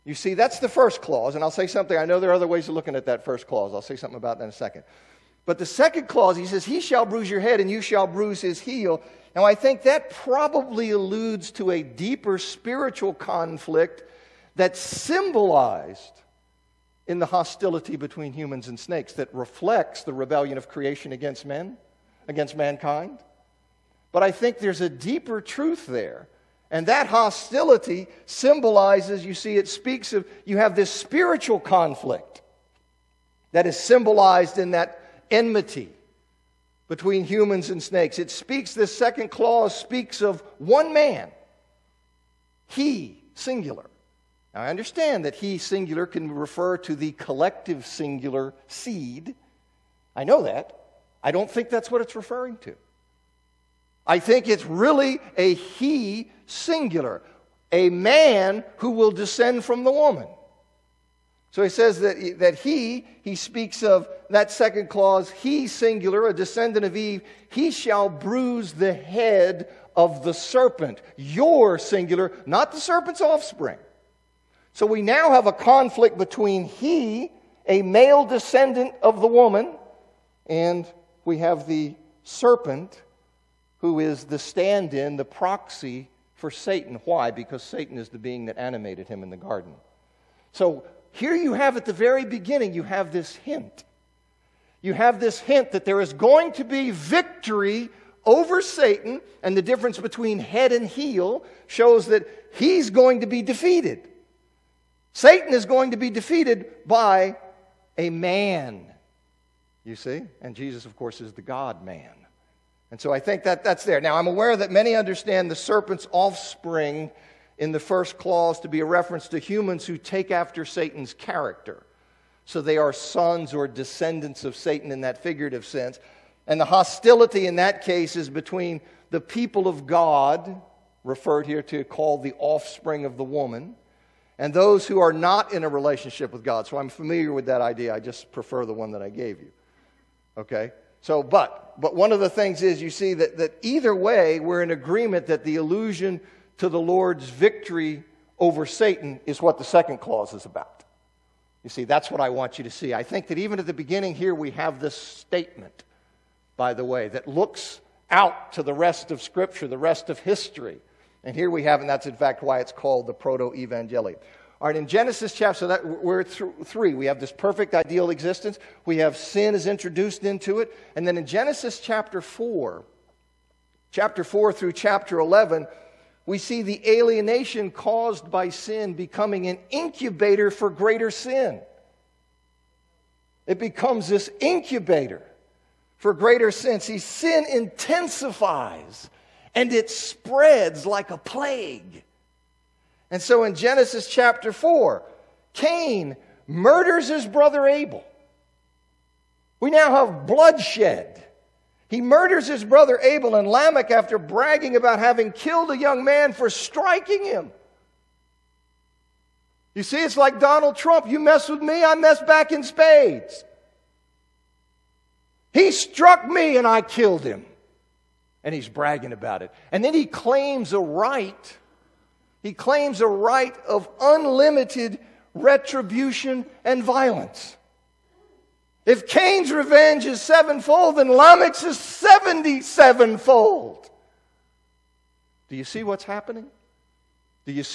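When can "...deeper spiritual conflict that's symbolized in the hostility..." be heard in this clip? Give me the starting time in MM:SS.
00:11.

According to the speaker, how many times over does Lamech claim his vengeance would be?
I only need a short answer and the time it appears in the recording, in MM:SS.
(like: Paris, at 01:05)
77, at 03:51.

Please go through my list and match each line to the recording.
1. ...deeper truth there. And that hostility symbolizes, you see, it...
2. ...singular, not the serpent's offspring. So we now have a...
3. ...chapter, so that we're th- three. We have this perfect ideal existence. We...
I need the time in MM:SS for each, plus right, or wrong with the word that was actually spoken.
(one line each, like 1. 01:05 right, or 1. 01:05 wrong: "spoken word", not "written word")
1. 00:24 right
2. 01:11 right
3. 02:45 right.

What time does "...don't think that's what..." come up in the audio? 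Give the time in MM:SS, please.
00:51.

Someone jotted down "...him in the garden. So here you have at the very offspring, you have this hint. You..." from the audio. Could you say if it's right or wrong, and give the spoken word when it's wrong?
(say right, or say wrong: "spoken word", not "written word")
wrong: "beginning", not "offspring".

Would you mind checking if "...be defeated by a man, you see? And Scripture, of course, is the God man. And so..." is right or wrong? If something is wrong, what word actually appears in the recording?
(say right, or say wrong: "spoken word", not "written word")
wrong: "Jesus", not "Scripture".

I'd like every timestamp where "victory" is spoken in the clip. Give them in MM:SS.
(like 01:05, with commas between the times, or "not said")
01:36, 02:27.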